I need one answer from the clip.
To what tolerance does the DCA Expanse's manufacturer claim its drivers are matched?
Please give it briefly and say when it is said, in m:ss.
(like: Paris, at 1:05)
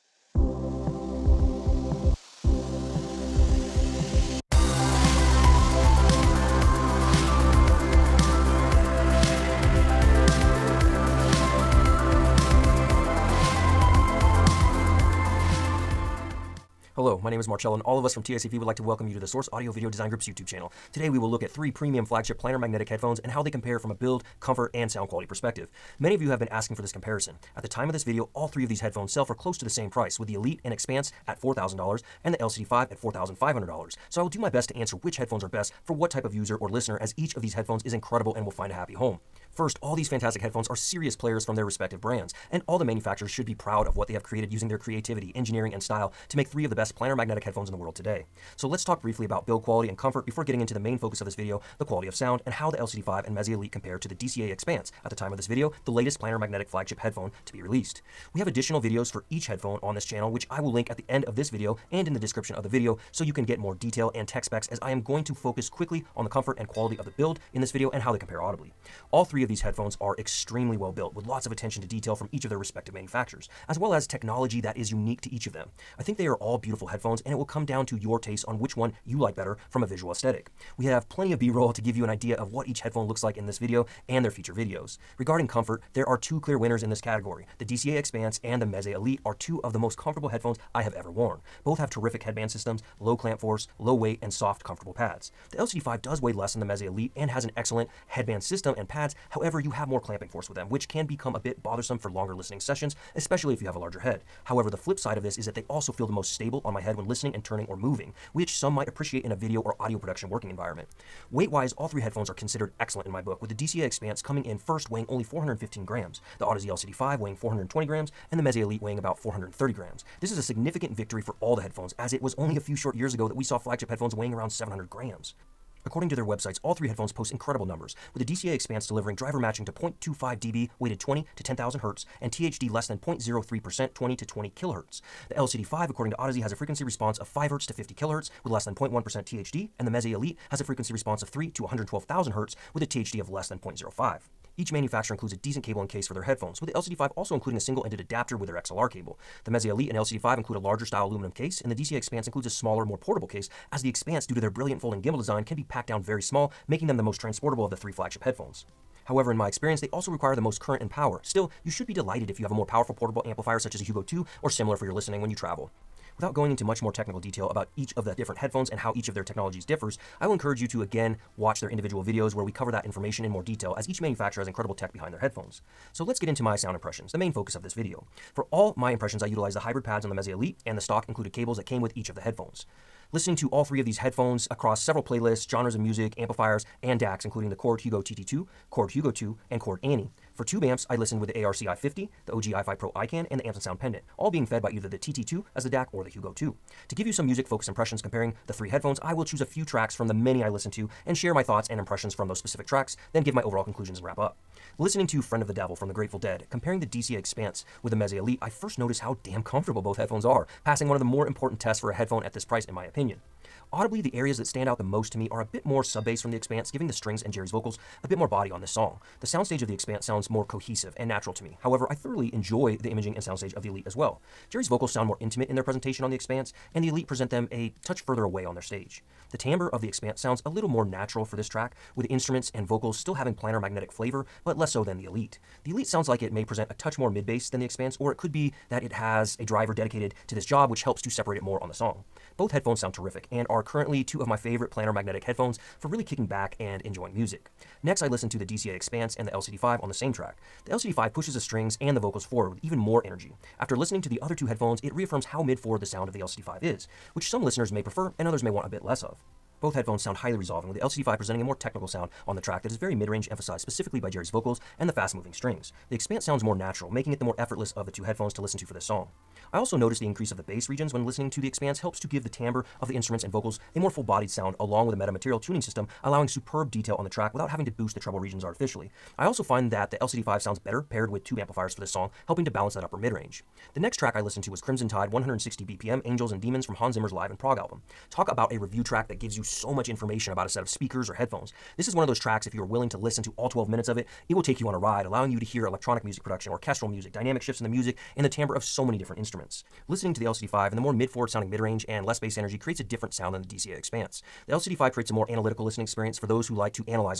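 0.25 dB, at 2:09.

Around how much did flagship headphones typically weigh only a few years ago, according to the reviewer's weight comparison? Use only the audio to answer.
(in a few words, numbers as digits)
700 grams.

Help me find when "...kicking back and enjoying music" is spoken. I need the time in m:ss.
4:06.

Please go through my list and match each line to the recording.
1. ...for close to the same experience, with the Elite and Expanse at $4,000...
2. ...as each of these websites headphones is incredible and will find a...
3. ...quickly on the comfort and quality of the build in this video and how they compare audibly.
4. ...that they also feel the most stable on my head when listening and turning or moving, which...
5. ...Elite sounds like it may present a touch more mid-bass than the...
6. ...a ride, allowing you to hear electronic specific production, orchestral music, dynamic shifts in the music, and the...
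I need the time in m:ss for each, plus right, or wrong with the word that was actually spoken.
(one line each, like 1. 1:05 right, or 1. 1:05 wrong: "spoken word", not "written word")
1. 0:29 wrong: "price", not "experience"
2. 0:36 wrong: "headphones", not "websites"
3. 1:05 right
4. 1:45 right
5. 3:55 right
6. 4:54 wrong: "music", not "specific".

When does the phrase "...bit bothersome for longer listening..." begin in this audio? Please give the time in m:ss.
1:41.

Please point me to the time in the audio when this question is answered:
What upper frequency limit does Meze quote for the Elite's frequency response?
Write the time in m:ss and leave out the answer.
2:21.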